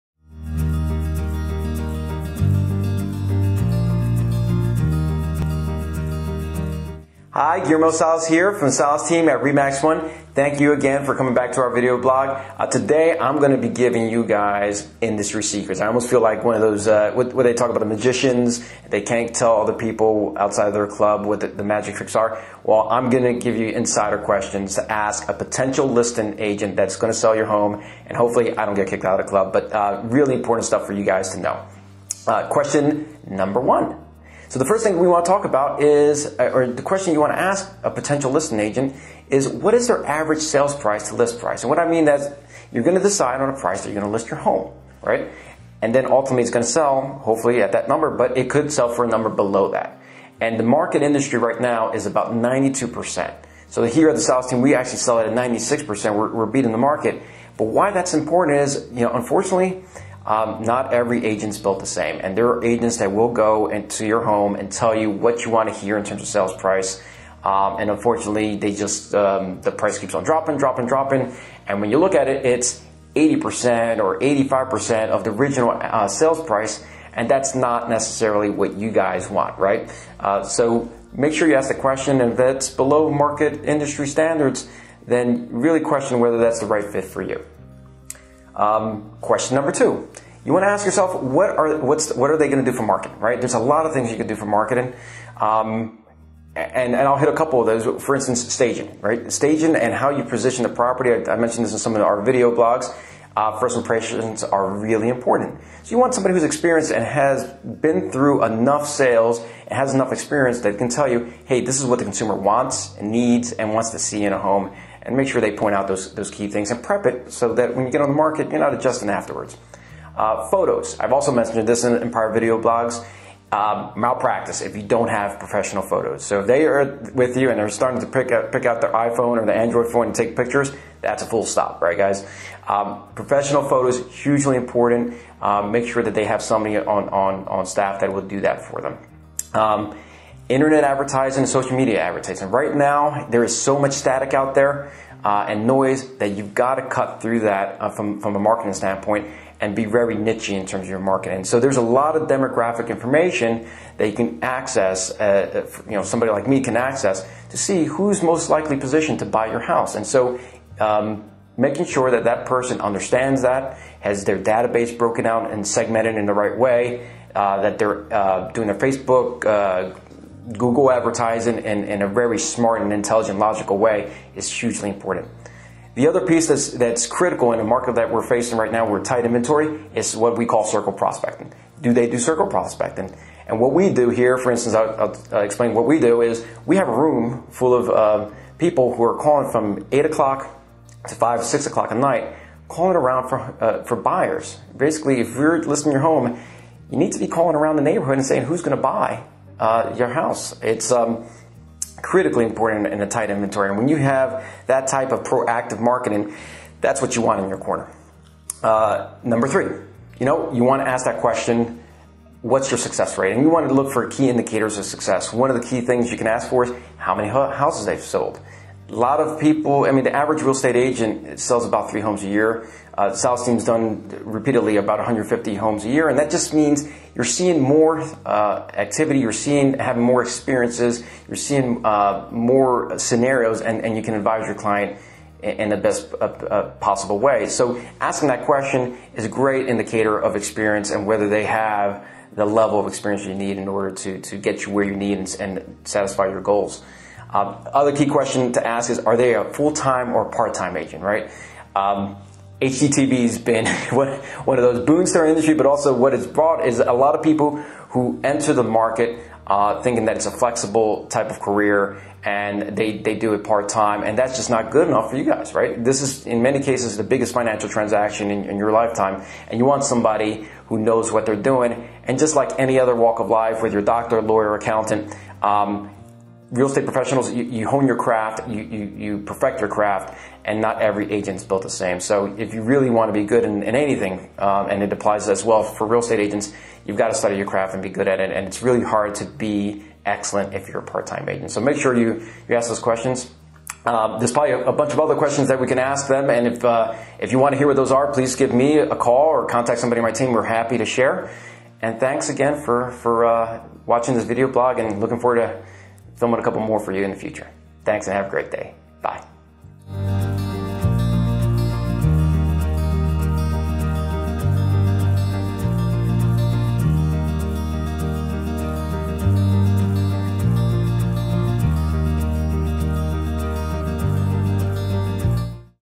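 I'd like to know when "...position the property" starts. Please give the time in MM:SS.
01:40.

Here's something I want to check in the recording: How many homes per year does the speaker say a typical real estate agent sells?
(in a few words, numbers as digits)
3.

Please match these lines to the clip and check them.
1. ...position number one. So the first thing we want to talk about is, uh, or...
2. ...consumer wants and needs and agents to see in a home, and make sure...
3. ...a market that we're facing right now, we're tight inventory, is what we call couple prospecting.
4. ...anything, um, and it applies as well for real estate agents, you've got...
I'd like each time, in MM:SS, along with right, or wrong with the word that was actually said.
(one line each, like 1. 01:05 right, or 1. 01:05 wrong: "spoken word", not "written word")
1. 00:32 wrong: "question", not "position"
2. 01:52 wrong: "wants", not "agents"
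3. 02:57 wrong: "circle", not "couple"
4. 04:43 right.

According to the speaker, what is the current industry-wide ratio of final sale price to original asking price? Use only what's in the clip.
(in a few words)
92%.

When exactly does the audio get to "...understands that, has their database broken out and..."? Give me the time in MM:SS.
02:42.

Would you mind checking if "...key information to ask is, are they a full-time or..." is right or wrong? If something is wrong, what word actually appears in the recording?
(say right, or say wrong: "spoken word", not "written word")
wrong: "question", not "information".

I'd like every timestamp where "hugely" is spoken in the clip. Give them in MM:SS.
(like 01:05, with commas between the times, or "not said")
02:14, 02:54.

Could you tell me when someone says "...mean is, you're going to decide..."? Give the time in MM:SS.
00:41.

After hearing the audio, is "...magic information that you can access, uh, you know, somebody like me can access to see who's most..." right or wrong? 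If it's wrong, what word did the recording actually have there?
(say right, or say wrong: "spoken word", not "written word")
wrong: "demographic", not "magic".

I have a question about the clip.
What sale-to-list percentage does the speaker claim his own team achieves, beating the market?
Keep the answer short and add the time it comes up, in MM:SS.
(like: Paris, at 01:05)
96%, at 00:55.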